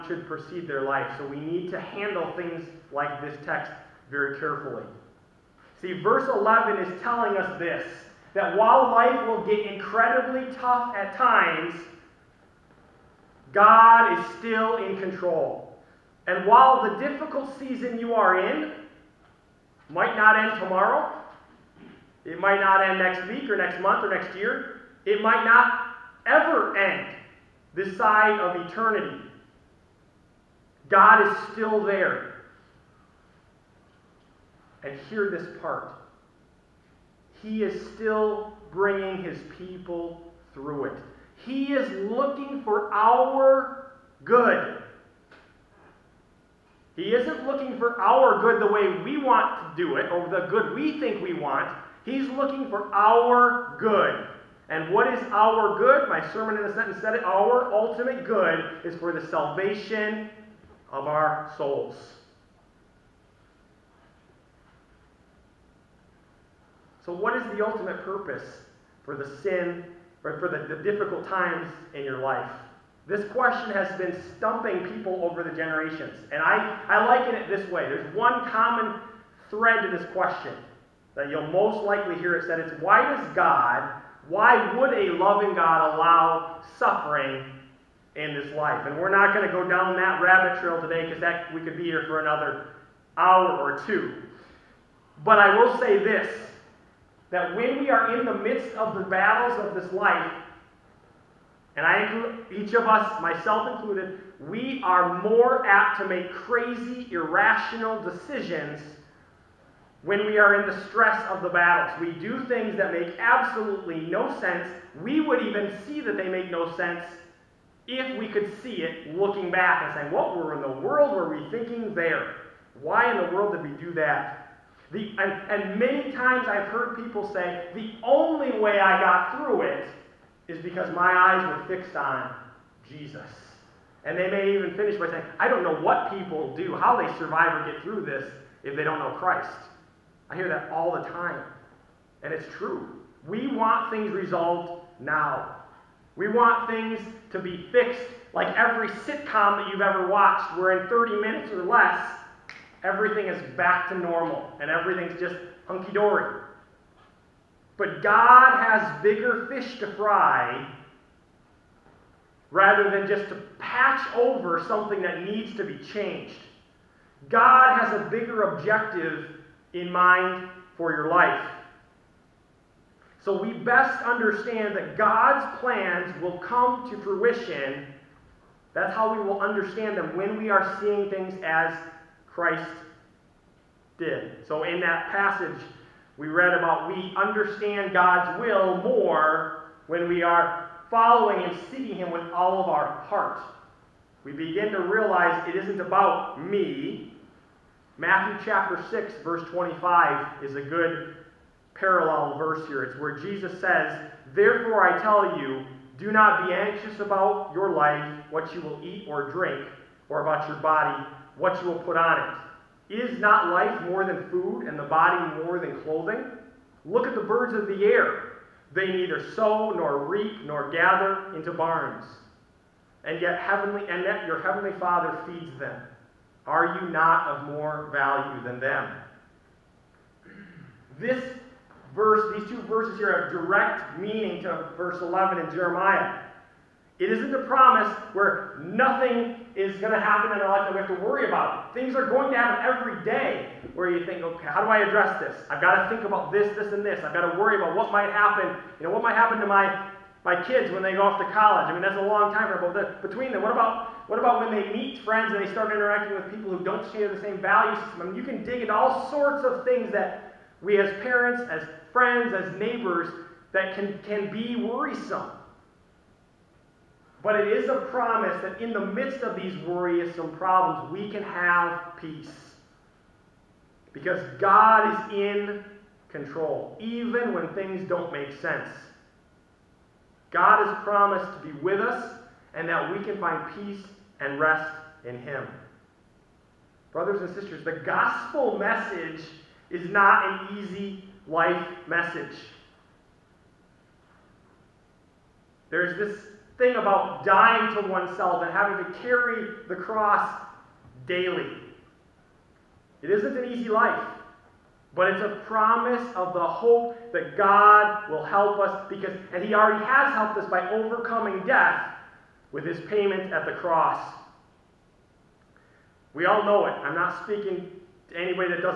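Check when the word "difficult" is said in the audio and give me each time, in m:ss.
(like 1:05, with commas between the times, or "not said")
0:17, 1:10.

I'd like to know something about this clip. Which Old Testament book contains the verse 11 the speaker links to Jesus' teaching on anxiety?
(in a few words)
Jeremiah.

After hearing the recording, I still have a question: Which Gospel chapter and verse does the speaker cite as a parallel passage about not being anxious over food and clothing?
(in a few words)
Matthew 6:25.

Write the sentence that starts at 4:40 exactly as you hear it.
God has promised to be with us and that we can find peace and rest in Him.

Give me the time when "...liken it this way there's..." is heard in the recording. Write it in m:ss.
1:17.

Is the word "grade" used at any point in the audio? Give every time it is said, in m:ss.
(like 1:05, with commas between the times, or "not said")
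not said.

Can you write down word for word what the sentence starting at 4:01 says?
Things are going to happen every day where you think, okay, how do I address this?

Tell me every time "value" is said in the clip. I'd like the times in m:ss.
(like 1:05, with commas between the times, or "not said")
3:47, 4:17.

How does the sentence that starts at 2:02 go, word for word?
Why in the world did we do that?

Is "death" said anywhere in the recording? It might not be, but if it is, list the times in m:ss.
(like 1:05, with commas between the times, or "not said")
5:11.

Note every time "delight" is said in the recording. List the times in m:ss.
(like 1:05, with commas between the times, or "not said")
not said.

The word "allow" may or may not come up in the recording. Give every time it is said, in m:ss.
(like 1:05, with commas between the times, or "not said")
1:25.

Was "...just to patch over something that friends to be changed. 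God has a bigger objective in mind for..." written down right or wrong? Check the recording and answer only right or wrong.
wrong.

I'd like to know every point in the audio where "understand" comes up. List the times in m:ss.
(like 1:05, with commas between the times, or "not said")
2:54, 2:59, 3:07.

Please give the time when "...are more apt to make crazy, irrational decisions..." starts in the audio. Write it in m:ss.
1:44.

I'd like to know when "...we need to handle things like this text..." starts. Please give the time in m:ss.
0:01.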